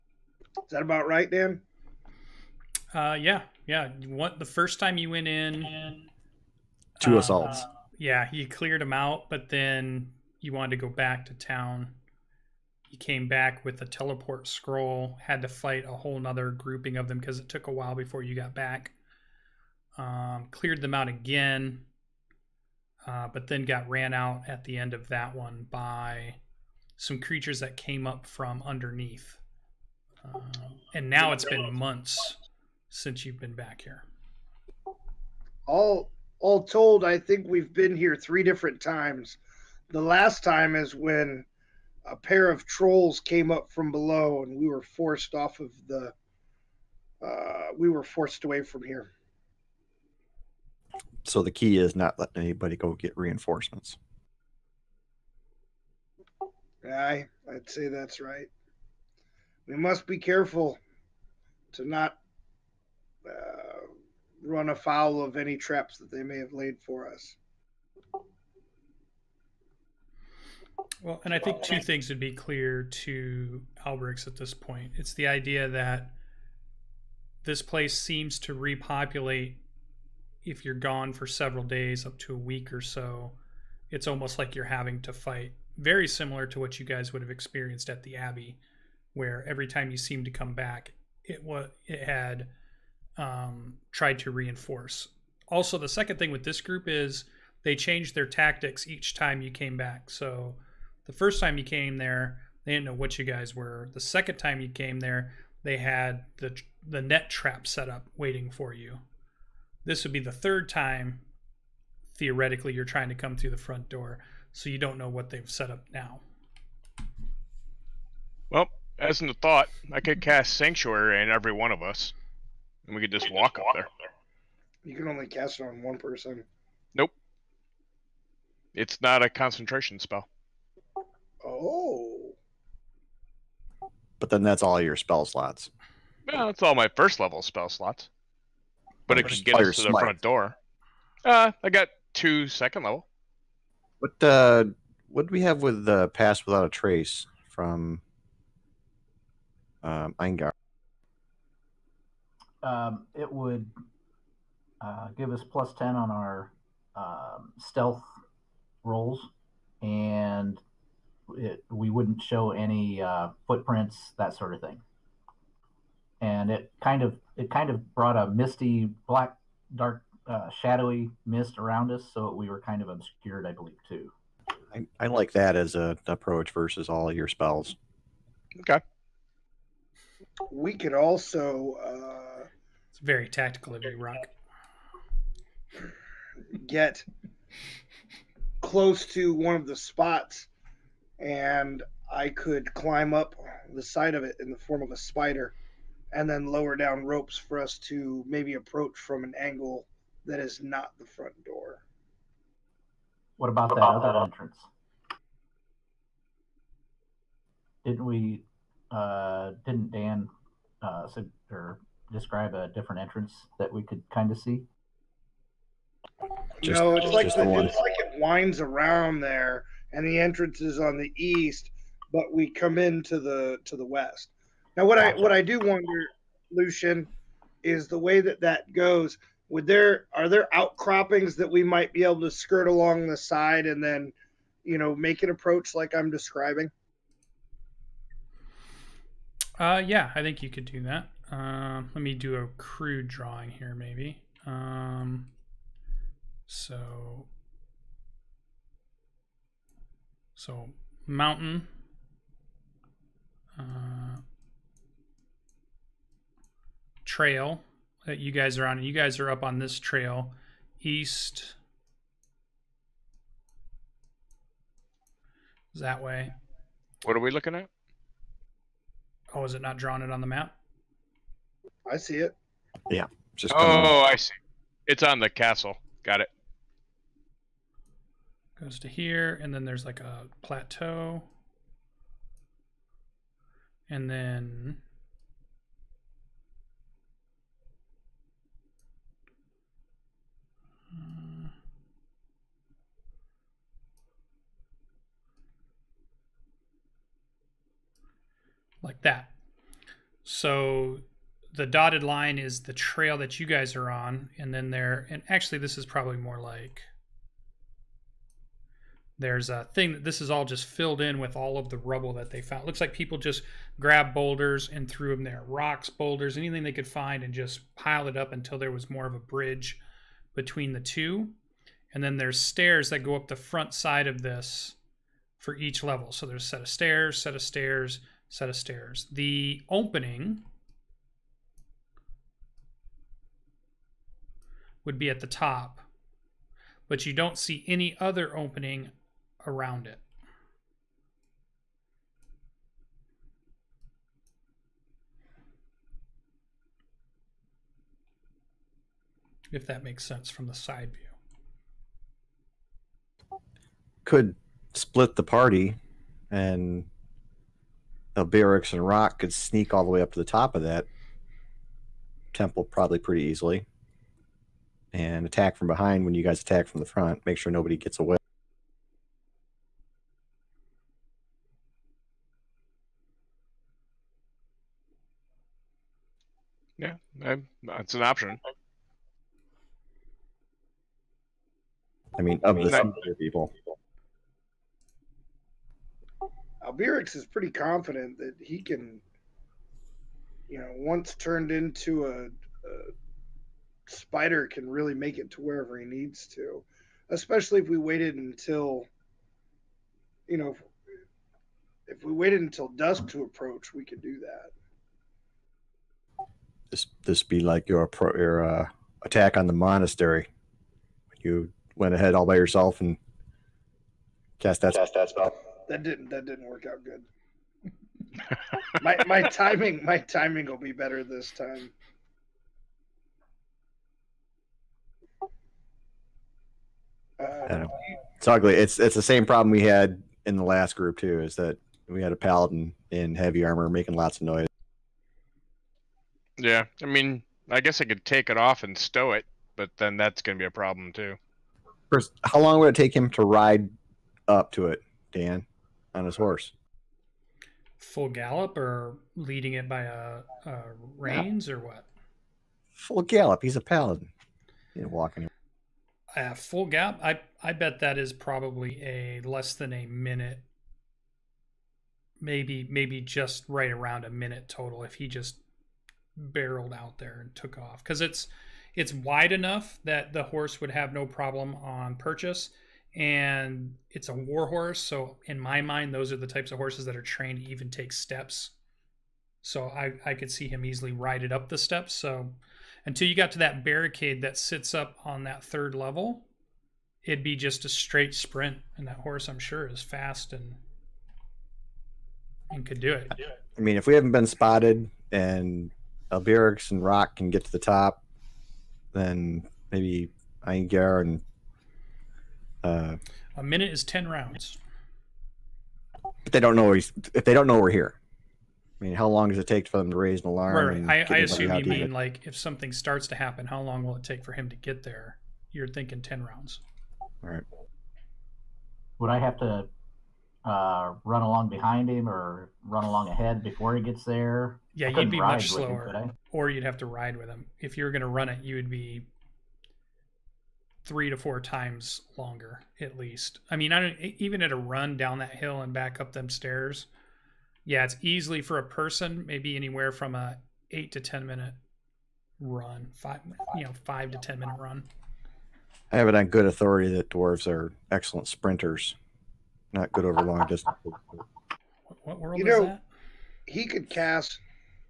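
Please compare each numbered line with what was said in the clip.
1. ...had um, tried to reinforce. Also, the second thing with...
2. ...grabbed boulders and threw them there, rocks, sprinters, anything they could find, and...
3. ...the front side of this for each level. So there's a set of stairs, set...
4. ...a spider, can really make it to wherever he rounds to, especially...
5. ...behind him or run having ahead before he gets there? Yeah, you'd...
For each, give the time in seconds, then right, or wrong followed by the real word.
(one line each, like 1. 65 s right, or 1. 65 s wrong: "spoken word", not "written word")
1. 92 s right
2. 313 s wrong: "boulders", not "sprinters"
3. 323 s right
4. 392 s wrong: "needs", not "rounds"
5. 521 s wrong: "along", not "having".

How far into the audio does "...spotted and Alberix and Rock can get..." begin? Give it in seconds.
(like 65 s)
494 s.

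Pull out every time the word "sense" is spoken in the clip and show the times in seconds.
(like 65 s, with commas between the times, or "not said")
350 s.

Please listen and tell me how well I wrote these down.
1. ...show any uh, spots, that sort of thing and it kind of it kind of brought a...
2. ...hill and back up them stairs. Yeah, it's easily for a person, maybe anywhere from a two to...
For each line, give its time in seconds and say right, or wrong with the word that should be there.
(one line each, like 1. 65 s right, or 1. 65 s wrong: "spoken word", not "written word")
1. 162 s wrong: "footprints", not "spots"
2. 535 s wrong: "eight", not "two".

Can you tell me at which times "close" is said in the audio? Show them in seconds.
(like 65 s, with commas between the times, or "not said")
188 s.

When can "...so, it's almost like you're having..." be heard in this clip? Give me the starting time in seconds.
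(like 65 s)
82 s.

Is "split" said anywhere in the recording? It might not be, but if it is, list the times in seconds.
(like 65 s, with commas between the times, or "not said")
354 s.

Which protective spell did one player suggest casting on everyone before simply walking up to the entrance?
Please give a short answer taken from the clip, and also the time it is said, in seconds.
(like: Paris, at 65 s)
Sanctuary, at 120 s.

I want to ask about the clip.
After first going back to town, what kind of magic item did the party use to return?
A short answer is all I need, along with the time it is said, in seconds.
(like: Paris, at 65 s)
Teleport scroll, at 13 s.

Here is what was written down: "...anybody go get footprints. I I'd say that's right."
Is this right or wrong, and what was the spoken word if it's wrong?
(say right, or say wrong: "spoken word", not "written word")
wrong: "reinforcements", not "footprints".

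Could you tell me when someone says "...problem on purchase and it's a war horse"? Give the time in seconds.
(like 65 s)
471 s.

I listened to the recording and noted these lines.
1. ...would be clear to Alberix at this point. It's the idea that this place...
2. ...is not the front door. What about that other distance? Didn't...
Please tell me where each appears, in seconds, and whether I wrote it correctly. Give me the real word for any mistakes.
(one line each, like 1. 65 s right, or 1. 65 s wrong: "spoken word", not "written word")
1. 72 s right
2. 200 s wrong: "entrance", not "distance".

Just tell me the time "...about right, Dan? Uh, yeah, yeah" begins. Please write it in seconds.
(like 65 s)
0 s.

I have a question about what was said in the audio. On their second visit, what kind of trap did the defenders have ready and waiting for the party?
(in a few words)
Net trap.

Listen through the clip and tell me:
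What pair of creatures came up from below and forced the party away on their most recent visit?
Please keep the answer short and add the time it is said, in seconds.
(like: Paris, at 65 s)
Trolls, at 42 s.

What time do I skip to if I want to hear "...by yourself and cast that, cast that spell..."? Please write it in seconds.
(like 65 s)
412 s.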